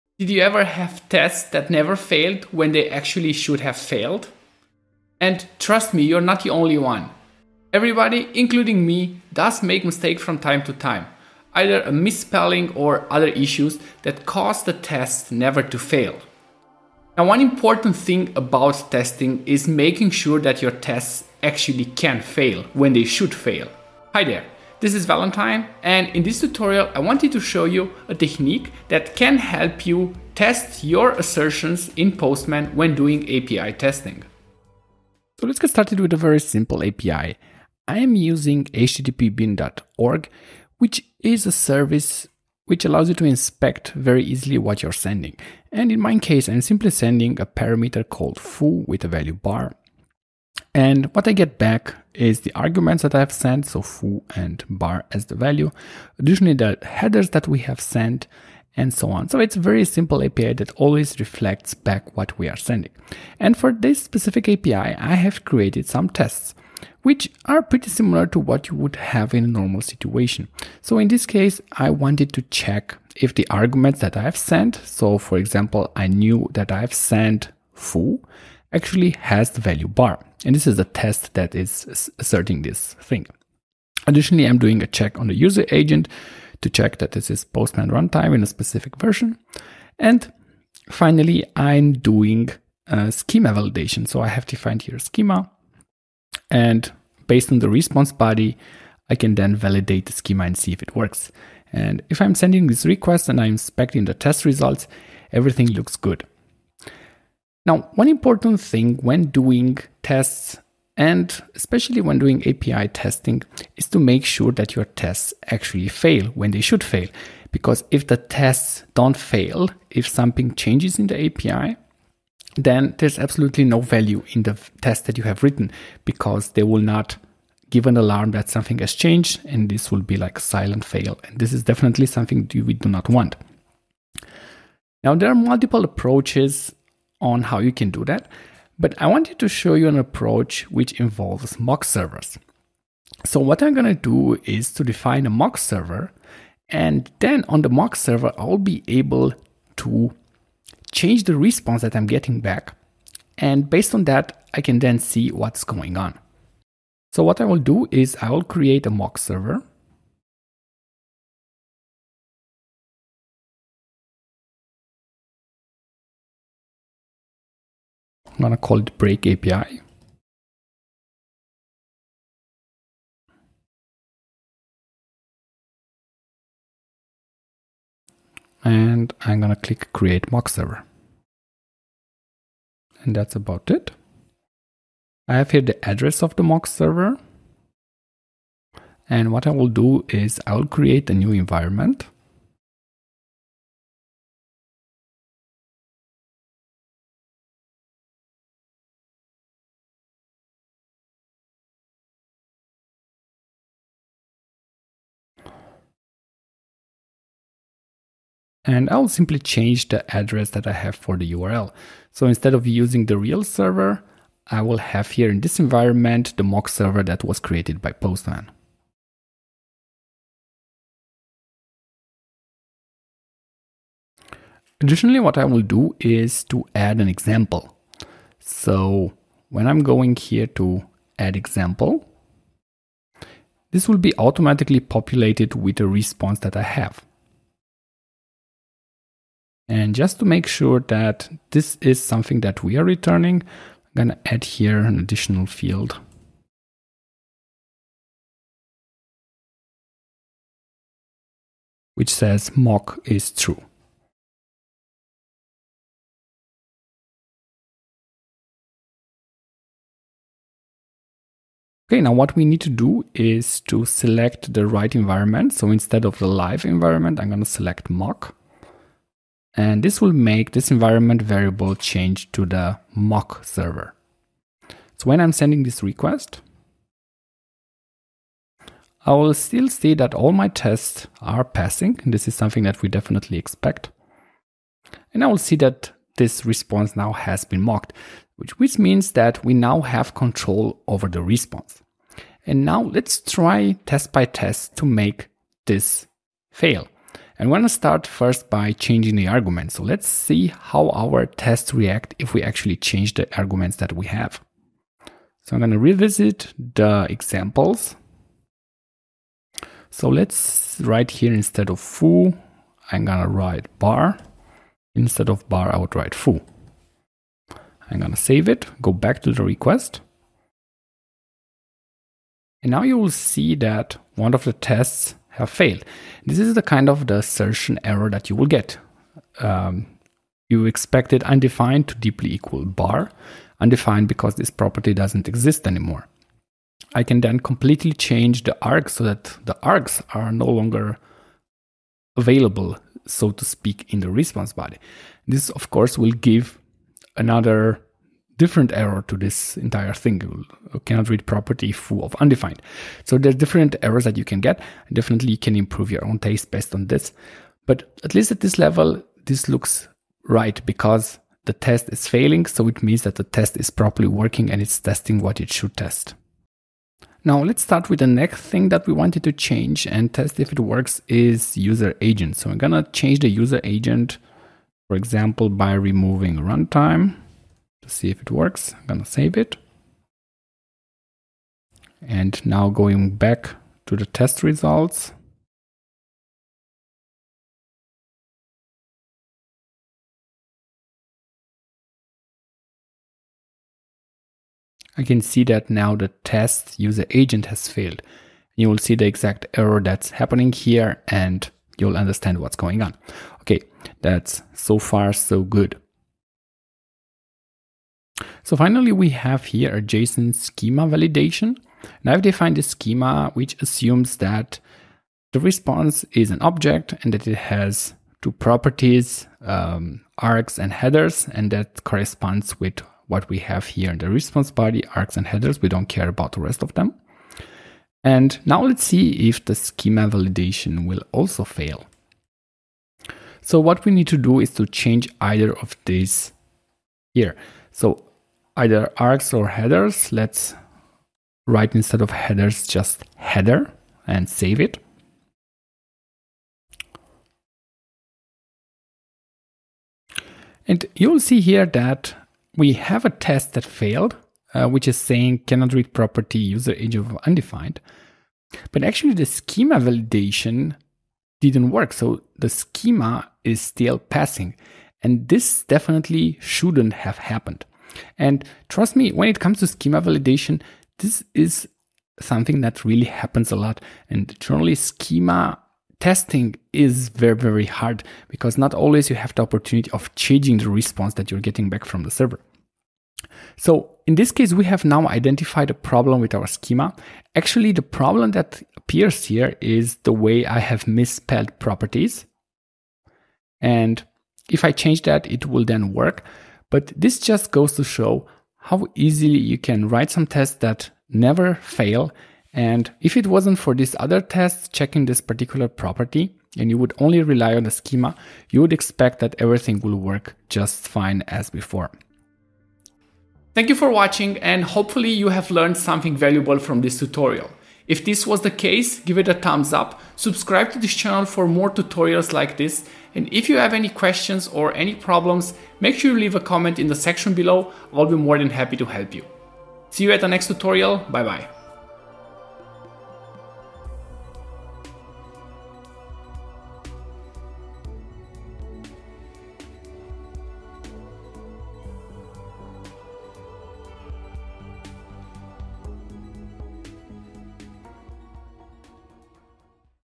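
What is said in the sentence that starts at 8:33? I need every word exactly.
Thank you for watching and hopefully you have learned something valuable from this tutorial.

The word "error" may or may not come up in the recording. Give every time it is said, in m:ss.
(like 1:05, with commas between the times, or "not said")
5:27, 5:48, 5:53, 6:39.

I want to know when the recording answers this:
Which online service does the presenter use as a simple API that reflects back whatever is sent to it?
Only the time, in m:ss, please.
0:38.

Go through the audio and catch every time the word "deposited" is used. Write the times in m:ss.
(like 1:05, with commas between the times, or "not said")
not said.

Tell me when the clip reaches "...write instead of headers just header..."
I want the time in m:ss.
7:21.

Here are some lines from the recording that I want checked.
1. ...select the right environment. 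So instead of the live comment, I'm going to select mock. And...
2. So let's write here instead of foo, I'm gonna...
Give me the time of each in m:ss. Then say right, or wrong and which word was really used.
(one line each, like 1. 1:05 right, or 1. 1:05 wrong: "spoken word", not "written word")
1. 4:23 wrong: "environment", not "comment"
2. 5:09 right.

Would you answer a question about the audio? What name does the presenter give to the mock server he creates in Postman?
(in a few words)
break API.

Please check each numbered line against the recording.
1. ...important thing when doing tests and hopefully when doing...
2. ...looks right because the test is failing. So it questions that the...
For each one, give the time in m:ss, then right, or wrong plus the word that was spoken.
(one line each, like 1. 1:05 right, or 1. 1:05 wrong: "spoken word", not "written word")
1. 1:48 wrong: "especially", not "hopefully"
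2. 5:59 wrong: "means", not "questions".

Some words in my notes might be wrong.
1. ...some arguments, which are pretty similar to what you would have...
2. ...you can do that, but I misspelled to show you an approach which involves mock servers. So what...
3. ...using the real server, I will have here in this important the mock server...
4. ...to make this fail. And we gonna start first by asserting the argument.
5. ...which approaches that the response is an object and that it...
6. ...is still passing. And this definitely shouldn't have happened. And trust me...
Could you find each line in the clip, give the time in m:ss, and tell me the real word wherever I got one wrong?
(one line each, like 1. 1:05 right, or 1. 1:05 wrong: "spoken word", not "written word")
1. 1:05 wrong: "tests", not "arguments"
2. 2:17 wrong: "wanted", not "misspelled"
3. 3:32 wrong: "environment", not "important"
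4. 4:54 wrong: "changing", not "asserting"
5. 6:53 wrong: "assumes", not "approaches"
6. 7:43 right.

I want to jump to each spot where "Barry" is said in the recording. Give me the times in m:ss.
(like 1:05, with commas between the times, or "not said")
not said.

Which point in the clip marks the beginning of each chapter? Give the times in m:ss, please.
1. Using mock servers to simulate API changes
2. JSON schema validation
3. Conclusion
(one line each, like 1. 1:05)
1. 0:35
2. 6:46
3. 8:33.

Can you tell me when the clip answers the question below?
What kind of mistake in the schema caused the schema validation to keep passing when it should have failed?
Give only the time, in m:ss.
8:10.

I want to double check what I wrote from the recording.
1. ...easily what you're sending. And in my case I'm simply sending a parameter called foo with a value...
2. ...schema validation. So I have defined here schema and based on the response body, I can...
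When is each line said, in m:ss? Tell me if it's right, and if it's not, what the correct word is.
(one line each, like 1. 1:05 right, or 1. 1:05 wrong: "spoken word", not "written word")
1. 0:44 right
2. 1:33 right.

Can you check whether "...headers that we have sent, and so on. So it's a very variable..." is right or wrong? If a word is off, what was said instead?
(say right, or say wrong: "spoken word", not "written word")
wrong: "simple", not "variable".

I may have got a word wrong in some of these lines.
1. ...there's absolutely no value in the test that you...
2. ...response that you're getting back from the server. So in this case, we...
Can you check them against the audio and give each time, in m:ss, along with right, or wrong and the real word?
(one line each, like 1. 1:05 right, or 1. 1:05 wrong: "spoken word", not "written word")
1. 2:02 right
2. 8:00 right.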